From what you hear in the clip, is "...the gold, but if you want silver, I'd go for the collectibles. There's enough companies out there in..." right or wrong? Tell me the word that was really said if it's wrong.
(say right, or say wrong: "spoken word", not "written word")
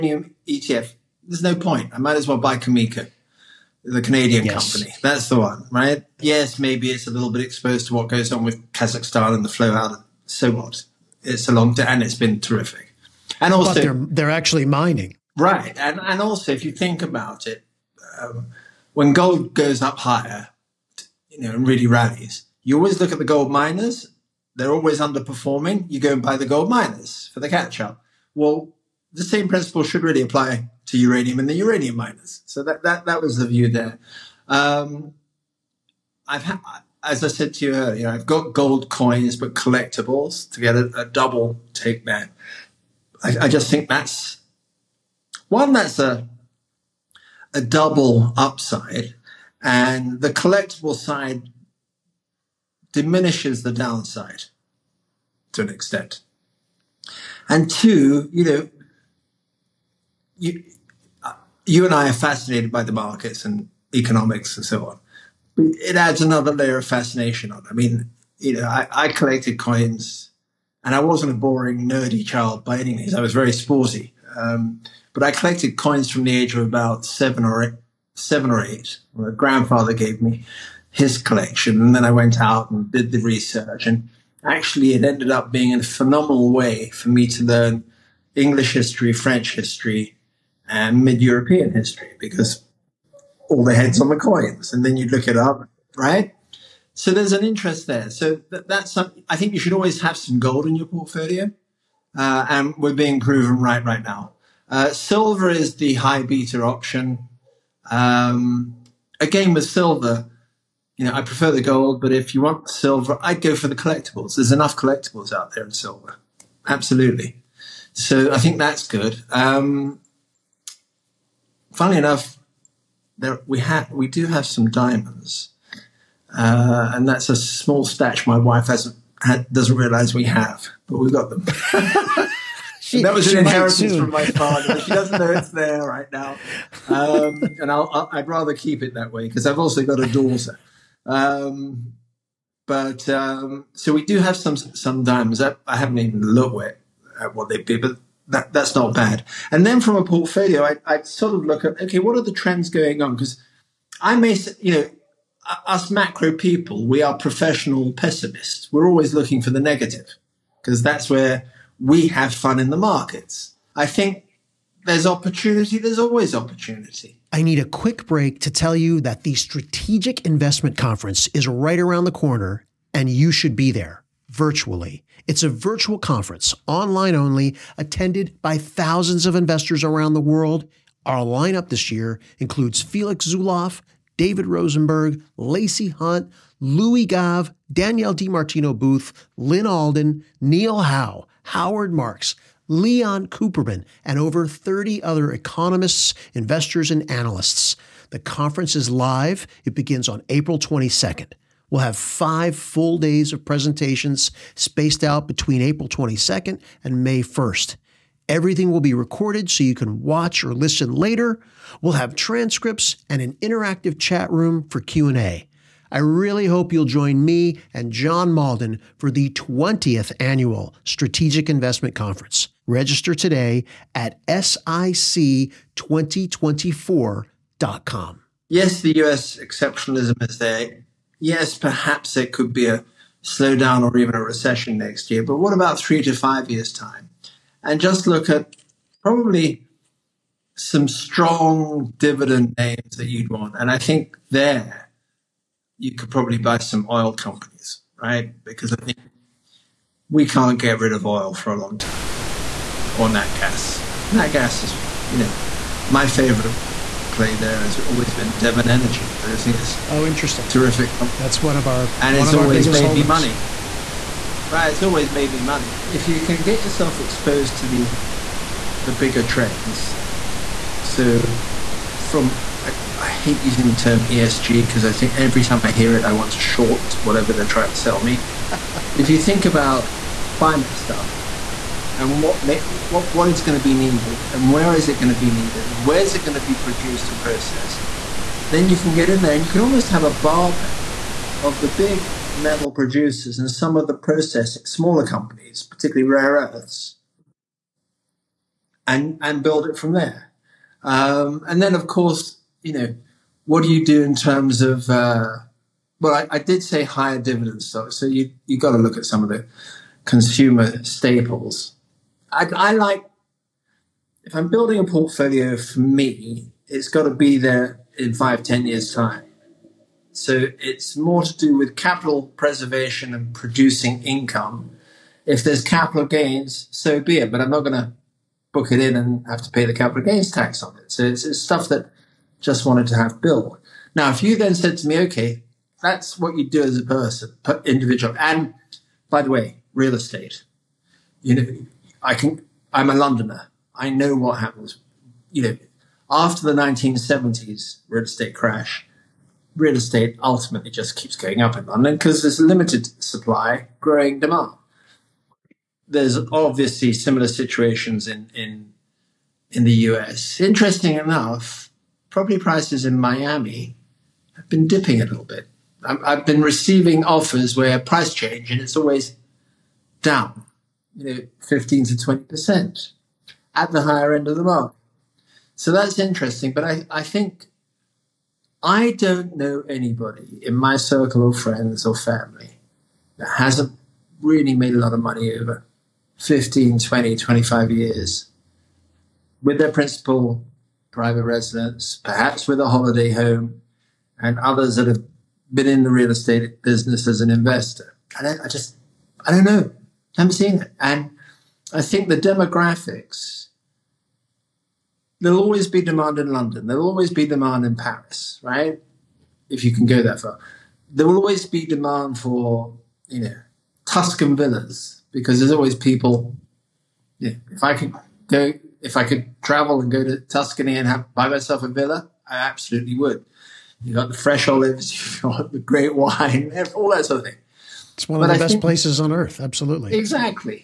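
wrong: "collectibles", not "companies".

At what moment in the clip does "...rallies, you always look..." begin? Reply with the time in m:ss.
0:21.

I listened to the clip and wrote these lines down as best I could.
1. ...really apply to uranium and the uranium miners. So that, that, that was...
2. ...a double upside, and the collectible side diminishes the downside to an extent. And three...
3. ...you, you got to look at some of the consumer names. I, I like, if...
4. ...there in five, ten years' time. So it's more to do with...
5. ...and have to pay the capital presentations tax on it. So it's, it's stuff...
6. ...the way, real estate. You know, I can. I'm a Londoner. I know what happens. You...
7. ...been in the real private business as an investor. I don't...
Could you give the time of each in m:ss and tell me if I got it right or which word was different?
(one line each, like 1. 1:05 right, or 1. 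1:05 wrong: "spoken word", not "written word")
1. 0:30 right
2. 0:47 wrong: "two", not "three"
3. 5:08 wrong: "staples", not "names"
4. 5:17 right
5. 5:28 wrong: "gains", not "presentations"
6. 5:39 right
7. 6:35 wrong: "estate", not "private".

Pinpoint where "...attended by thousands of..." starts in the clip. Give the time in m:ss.
2:57.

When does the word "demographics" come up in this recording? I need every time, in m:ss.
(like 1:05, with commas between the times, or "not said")
6:42.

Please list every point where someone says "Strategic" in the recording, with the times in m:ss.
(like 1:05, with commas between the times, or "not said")
2:49, 3:40.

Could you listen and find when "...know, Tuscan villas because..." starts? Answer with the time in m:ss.
6:53.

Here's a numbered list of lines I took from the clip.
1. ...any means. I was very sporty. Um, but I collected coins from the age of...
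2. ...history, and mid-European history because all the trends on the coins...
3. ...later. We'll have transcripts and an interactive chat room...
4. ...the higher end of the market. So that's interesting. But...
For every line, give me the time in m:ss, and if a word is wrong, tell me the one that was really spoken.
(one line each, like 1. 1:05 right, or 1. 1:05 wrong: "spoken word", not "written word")
1. 1:12 right
2. 1:29 wrong: "heads", not "trends"
3. 3:30 right
4. 6:13 right.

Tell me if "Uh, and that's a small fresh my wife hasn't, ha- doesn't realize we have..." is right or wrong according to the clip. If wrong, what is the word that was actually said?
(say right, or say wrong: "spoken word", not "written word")
wrong: "stash", not "fresh".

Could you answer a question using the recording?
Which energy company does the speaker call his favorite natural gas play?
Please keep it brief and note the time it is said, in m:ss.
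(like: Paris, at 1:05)
Devon Energy, at 4:18.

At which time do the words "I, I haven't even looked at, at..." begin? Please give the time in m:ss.
2:25.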